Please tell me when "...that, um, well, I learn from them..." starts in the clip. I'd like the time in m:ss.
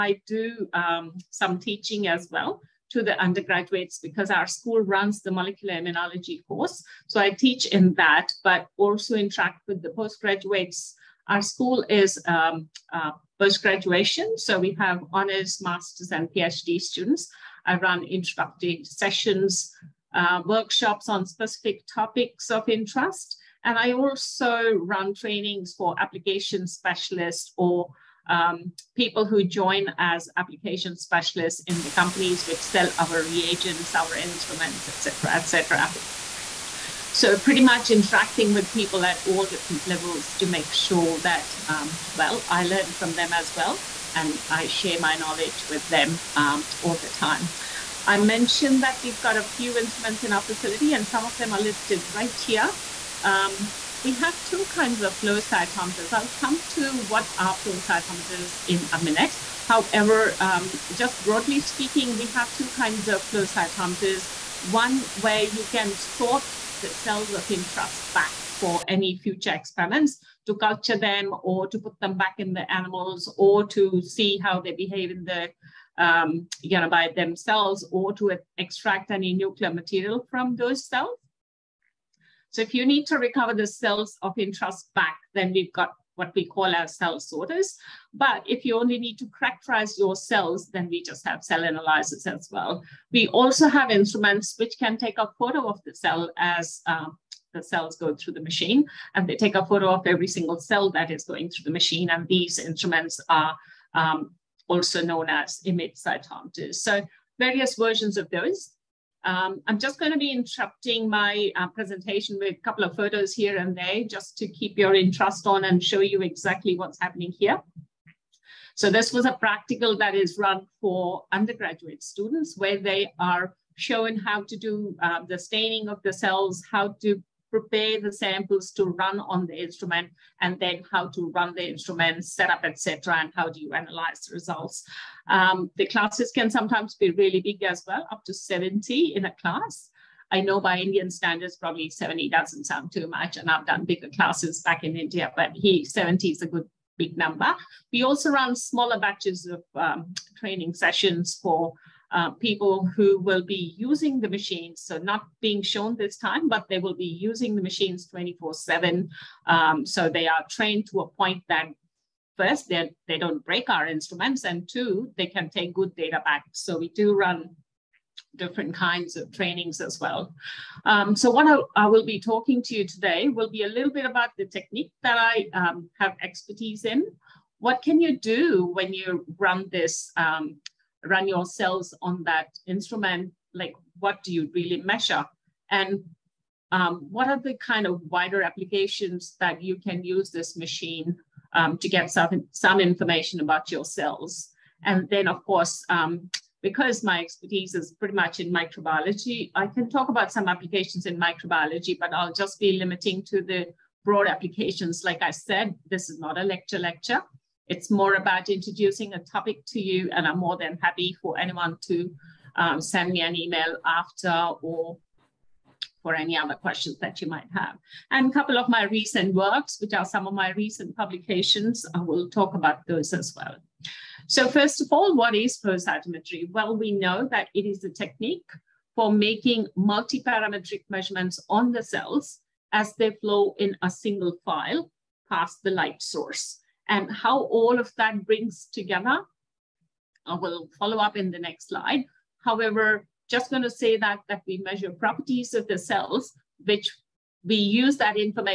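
0:41.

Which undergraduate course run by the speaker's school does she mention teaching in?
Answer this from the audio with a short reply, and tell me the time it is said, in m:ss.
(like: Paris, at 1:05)
Molecular immunology, at 0:05.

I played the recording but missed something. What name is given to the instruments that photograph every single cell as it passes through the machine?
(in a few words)
Image cytometers.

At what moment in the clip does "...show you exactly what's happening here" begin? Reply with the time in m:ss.
1:55.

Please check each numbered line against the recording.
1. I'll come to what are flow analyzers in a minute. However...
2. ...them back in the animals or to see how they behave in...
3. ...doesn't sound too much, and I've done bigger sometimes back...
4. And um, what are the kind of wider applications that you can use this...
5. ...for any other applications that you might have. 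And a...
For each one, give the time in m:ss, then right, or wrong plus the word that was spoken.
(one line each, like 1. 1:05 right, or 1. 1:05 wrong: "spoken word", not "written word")
1. 0:56 wrong: "cytometers", not "analyzers"
2. 1:11 right
3. 2:22 wrong: "classes", not "sometimes"
4. 3:05 right
5. 3:36 wrong: "questions", not "applications".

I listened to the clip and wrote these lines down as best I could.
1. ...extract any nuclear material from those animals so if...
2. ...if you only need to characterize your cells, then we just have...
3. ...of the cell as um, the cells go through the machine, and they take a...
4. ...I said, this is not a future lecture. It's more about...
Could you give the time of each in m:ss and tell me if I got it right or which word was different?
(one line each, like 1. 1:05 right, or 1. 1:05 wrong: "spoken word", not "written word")
1. 1:18 wrong: "cells", not "animals"
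2. 1:28 right
3. 1:35 right
4. 3:25 wrong: "lecture", not "future".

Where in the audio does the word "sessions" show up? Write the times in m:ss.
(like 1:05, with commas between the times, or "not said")
0:18, 2:30.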